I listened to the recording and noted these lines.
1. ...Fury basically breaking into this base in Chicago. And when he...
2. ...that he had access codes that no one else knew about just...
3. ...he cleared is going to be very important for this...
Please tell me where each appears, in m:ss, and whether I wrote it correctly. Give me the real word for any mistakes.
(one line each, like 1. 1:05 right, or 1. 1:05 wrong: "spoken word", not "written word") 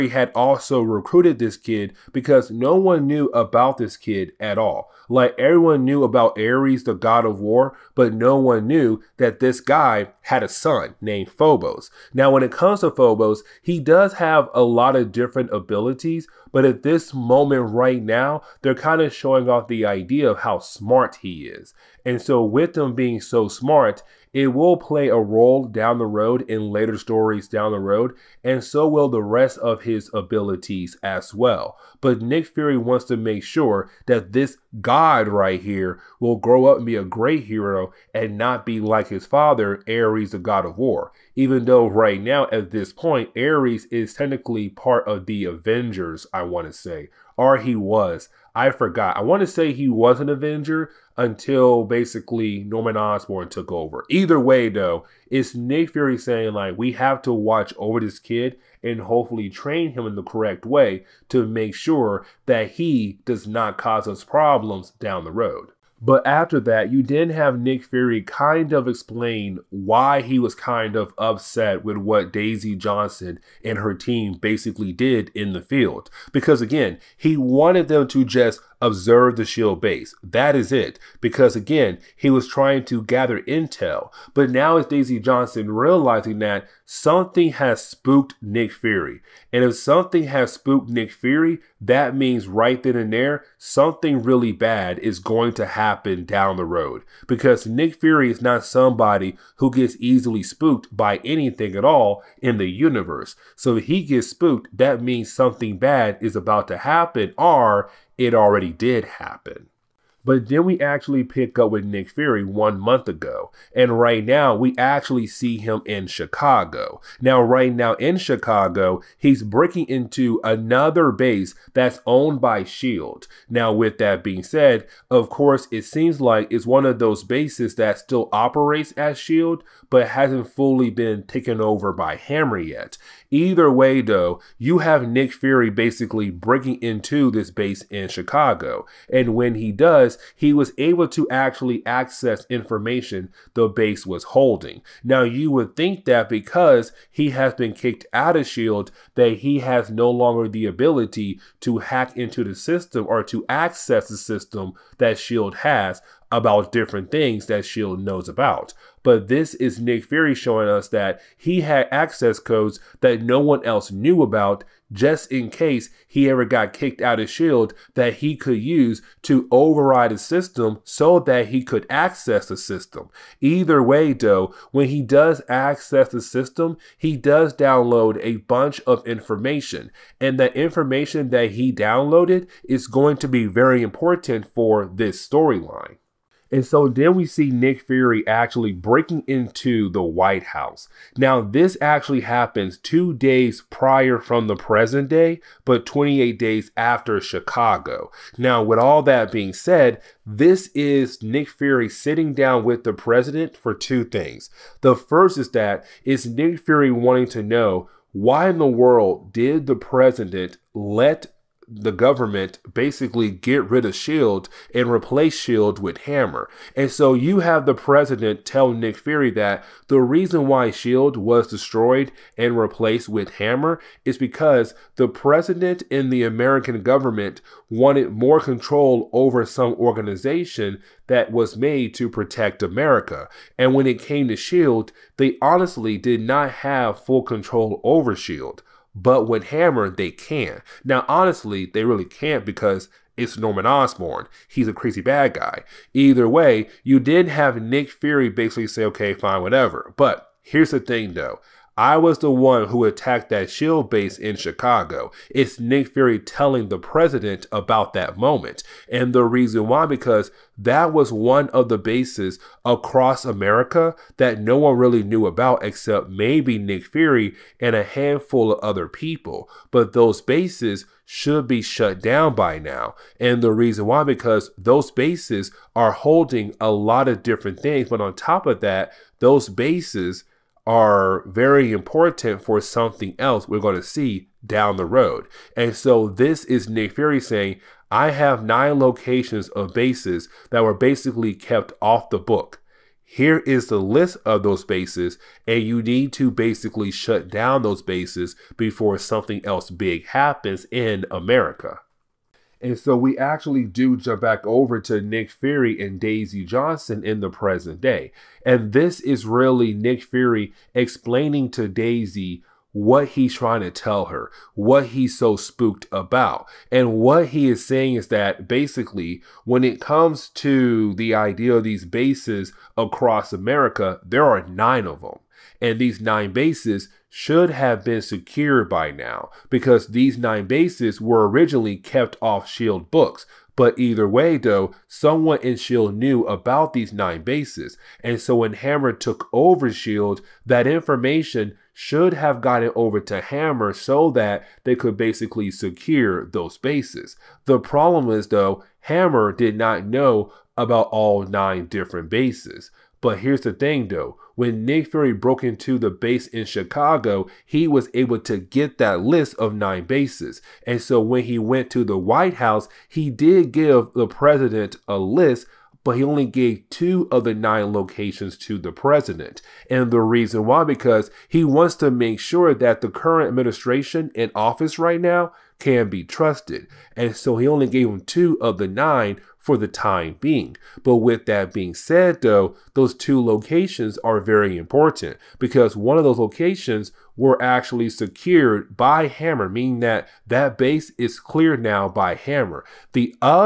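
1. 2:15 right
2. 2:40 right
3. 3:01 wrong: "downloaded", not "cleared".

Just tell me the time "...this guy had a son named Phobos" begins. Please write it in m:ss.
0:09.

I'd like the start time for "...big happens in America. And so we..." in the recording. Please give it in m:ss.
4:59.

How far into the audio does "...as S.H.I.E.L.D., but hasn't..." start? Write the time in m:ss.
2:08.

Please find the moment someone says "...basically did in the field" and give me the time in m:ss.
1:14.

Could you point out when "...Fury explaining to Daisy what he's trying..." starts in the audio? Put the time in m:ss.
5:10.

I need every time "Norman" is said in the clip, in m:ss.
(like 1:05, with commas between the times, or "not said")
0:52, 4:03.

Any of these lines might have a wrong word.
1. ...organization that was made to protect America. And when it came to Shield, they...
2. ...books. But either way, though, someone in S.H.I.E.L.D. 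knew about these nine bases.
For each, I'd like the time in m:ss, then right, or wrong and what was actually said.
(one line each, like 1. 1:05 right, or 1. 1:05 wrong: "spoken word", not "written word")
1. 3:49 right
2. 5:32 right.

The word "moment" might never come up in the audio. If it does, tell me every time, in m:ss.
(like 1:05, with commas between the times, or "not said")
0:17, 4:18.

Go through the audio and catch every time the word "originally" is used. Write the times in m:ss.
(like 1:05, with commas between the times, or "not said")
5:31.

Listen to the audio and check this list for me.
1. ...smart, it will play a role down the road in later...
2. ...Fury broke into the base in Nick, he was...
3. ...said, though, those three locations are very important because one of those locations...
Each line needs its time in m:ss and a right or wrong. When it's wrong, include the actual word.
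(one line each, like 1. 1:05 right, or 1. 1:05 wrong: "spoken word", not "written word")
1. 0:23 right
2. 5:54 wrong: "Chicago", not "Nick"
3. 6:21 wrong: "two", not "three".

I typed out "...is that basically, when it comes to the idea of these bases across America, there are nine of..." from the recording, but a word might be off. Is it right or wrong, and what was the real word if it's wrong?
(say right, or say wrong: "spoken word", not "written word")
right.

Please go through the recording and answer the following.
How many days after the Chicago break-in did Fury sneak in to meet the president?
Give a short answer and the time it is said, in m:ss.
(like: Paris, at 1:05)
28, at 3:15.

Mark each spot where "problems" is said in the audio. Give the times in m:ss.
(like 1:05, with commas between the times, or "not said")
1:04, 5:47.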